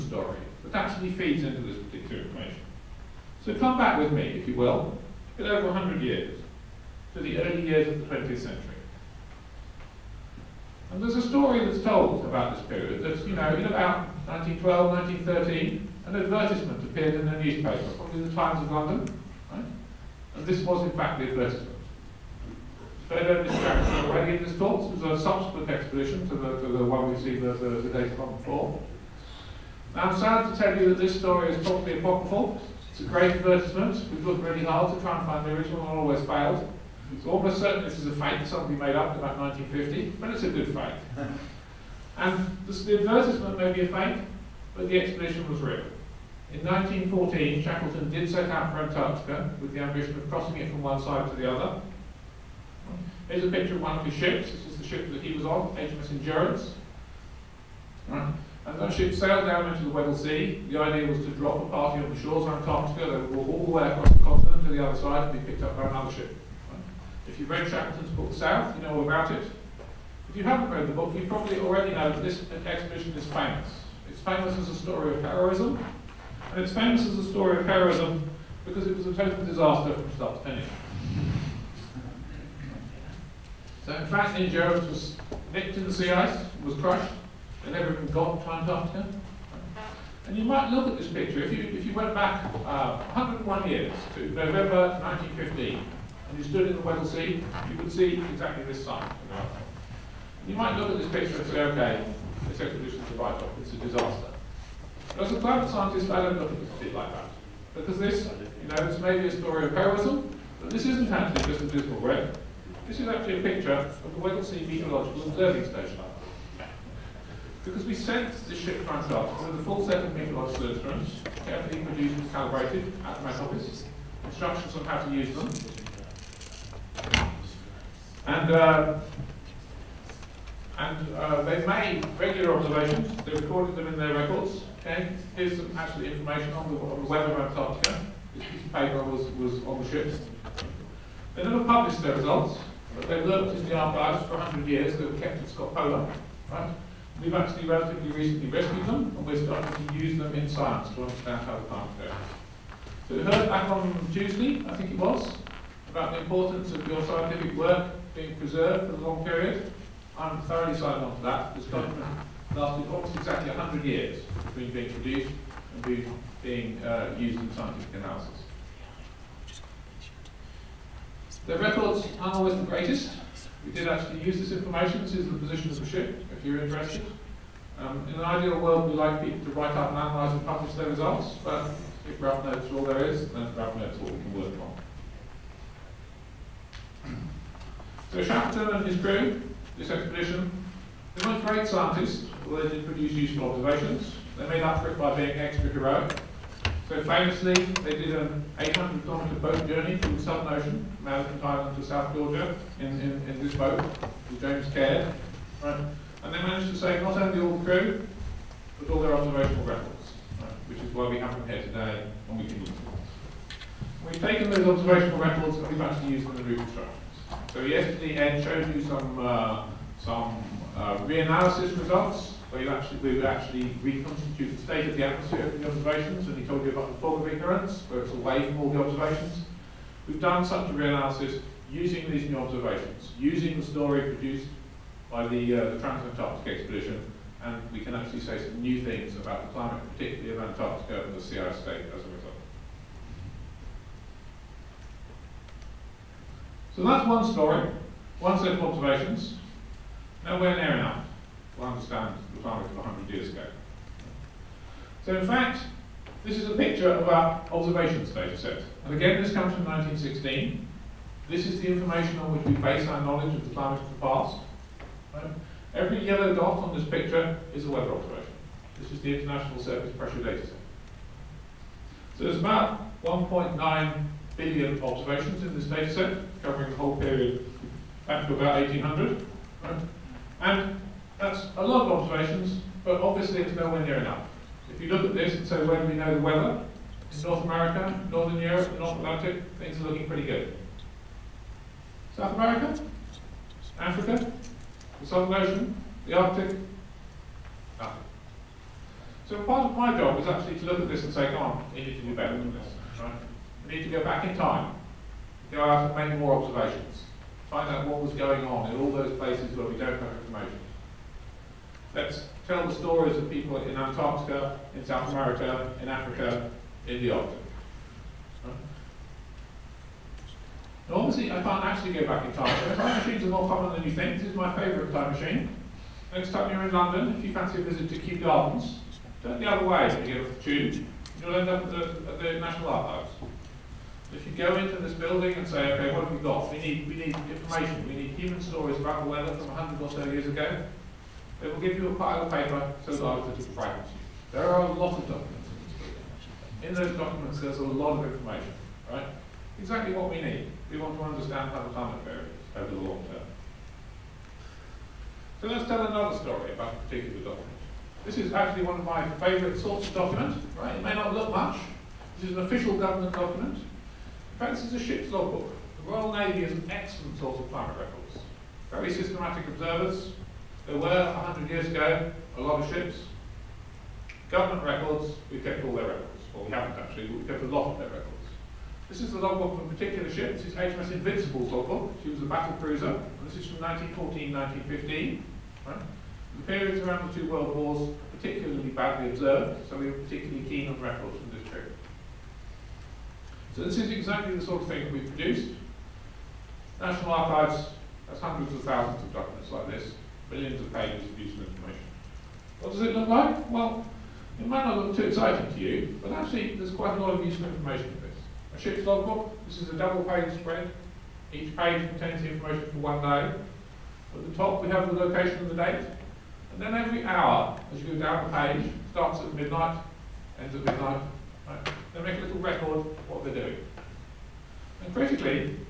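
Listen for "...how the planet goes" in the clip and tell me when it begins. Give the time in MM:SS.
02:31.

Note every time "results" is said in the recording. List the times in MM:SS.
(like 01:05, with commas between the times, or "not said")
02:22, 03:00, 03:41, 04:01.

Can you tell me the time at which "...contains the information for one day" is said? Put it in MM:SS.
06:51.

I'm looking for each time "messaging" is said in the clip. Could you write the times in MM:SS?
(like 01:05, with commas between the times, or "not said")
not said.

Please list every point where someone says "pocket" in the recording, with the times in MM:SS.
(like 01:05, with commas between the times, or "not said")
not said.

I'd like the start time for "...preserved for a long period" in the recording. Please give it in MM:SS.
02:38.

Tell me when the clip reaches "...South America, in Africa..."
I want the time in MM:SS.
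05:14.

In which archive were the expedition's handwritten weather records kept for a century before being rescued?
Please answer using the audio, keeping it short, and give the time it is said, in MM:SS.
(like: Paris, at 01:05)
Scott Polar, at 02:25.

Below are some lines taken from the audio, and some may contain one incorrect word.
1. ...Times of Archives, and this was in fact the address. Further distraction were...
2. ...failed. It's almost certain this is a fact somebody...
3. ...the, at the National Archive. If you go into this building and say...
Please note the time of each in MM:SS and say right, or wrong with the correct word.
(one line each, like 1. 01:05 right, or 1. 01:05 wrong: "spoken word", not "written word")
1. 00:18 wrong: "London", not "Archives"
2. 00:36 right
3. 05:31 right.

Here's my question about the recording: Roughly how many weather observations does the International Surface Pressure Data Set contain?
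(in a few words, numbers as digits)
1.9 billion.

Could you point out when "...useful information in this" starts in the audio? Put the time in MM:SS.
06:47.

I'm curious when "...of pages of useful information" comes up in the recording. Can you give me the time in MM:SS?
06:40.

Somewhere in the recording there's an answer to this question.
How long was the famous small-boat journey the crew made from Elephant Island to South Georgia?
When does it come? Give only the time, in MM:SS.
03:18.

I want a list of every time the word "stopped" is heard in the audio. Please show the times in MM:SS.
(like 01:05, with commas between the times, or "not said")
not said.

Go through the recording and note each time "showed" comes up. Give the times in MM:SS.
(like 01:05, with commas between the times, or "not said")
03:38.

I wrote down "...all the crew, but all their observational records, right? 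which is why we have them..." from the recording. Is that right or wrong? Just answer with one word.
right.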